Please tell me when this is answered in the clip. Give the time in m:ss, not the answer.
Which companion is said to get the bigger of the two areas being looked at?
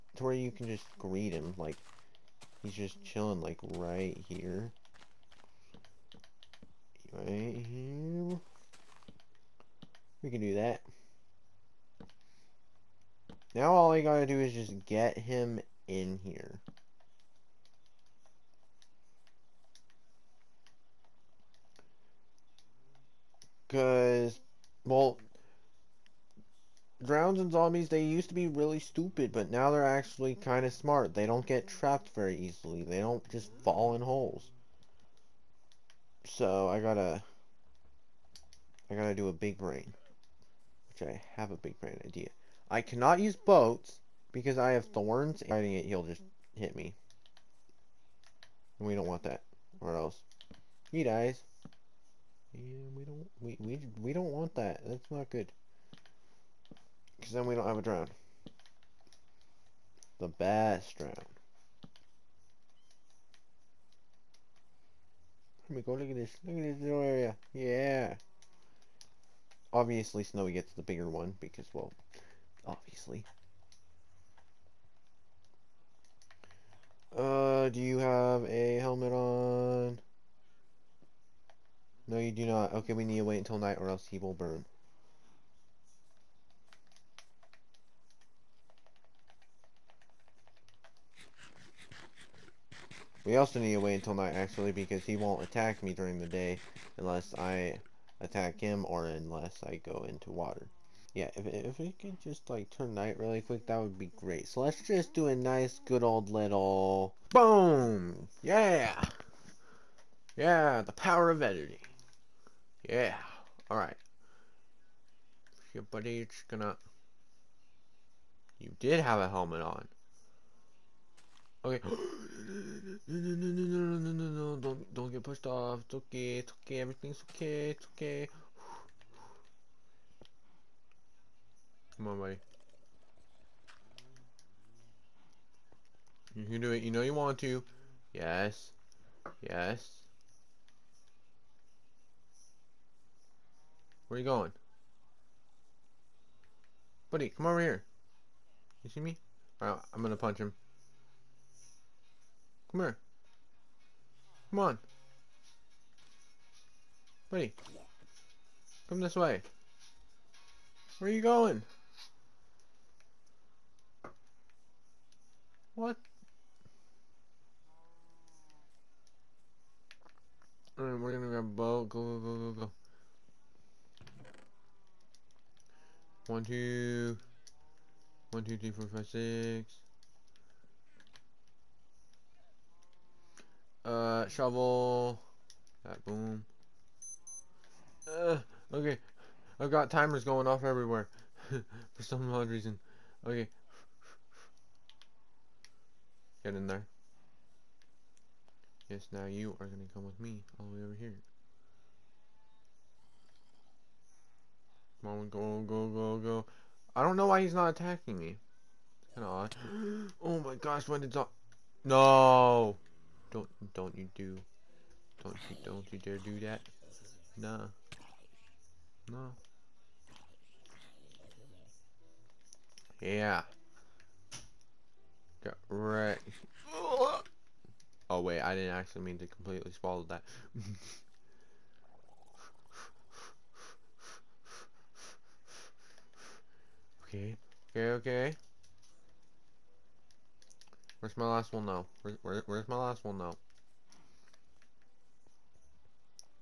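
1:10.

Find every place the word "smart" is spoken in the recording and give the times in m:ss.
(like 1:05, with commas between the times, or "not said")
0:30.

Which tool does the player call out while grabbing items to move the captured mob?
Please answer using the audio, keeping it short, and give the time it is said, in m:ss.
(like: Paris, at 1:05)
Shovel, at 3:04.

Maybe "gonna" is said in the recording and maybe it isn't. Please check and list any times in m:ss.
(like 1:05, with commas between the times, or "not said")
1:56, 2:30, 2:51.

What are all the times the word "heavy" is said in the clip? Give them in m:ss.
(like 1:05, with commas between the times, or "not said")
not said.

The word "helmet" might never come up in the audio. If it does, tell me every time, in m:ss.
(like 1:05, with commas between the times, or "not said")
1:18, 1:59.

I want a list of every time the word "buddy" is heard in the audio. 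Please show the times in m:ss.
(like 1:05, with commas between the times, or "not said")
1:55, 2:12, 2:27, 2:37.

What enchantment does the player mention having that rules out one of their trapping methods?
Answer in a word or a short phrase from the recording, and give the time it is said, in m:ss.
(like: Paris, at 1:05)
Thorns, at 0:44.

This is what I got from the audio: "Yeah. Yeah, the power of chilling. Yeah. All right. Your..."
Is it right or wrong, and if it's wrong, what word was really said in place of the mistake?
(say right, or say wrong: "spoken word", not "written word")
wrong: "editing", not "chilling".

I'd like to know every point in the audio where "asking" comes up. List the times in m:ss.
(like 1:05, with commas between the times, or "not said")
not said.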